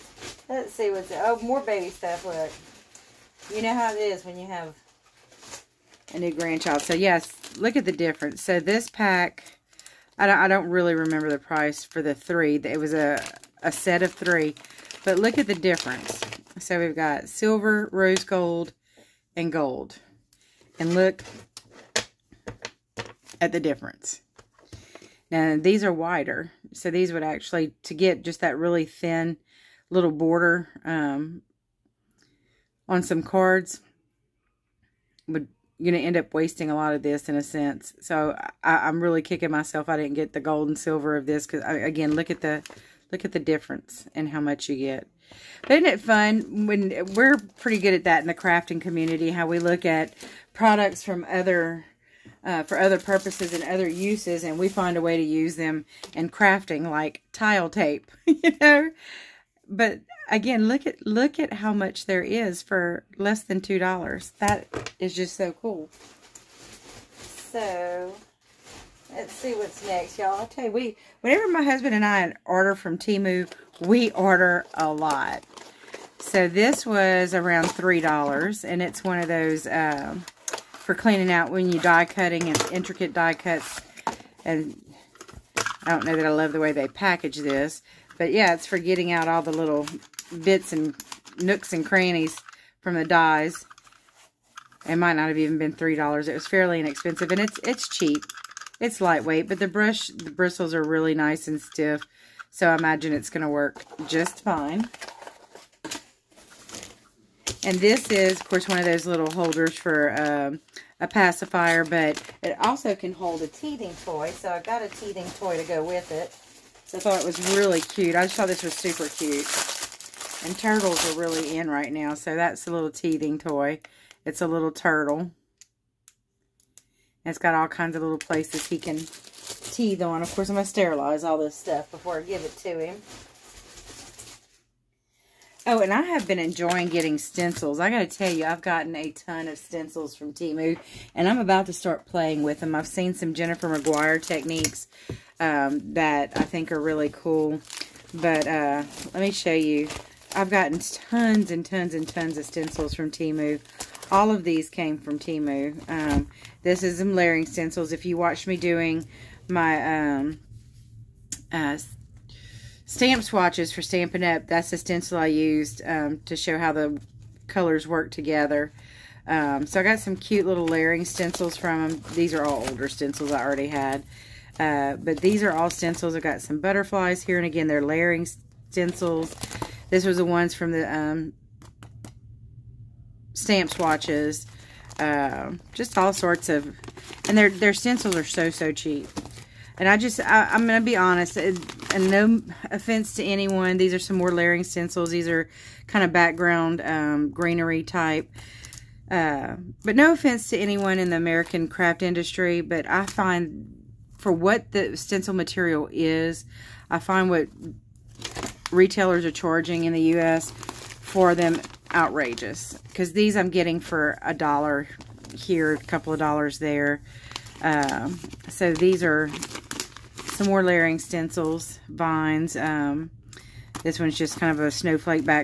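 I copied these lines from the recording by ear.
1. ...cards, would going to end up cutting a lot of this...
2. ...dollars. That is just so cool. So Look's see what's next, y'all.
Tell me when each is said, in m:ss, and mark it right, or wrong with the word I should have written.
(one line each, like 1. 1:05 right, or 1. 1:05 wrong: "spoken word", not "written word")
1. 0:33 wrong: "wasting", not "cutting"
2. 1:03 wrong: "Let", not "Look".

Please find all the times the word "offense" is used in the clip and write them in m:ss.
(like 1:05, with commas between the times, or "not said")
3:12, 3:20.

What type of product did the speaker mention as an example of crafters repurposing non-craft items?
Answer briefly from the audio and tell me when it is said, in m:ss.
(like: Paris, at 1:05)
tile tape, at 0:57.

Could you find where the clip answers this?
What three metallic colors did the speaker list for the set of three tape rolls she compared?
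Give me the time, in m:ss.
0:17.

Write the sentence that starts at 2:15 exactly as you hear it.
Oh, and I have been enjoying getting stencils.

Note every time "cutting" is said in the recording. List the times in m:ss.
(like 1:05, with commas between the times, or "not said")
1:22.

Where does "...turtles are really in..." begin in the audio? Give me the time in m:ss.
2:00.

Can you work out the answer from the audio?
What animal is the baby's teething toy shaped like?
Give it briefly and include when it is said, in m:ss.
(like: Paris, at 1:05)
turtle, at 2:04.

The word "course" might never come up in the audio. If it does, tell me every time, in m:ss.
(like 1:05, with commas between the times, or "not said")
1:48, 2:10.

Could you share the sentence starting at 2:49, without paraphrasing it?
Um, so I got some cute little layering stencils from them.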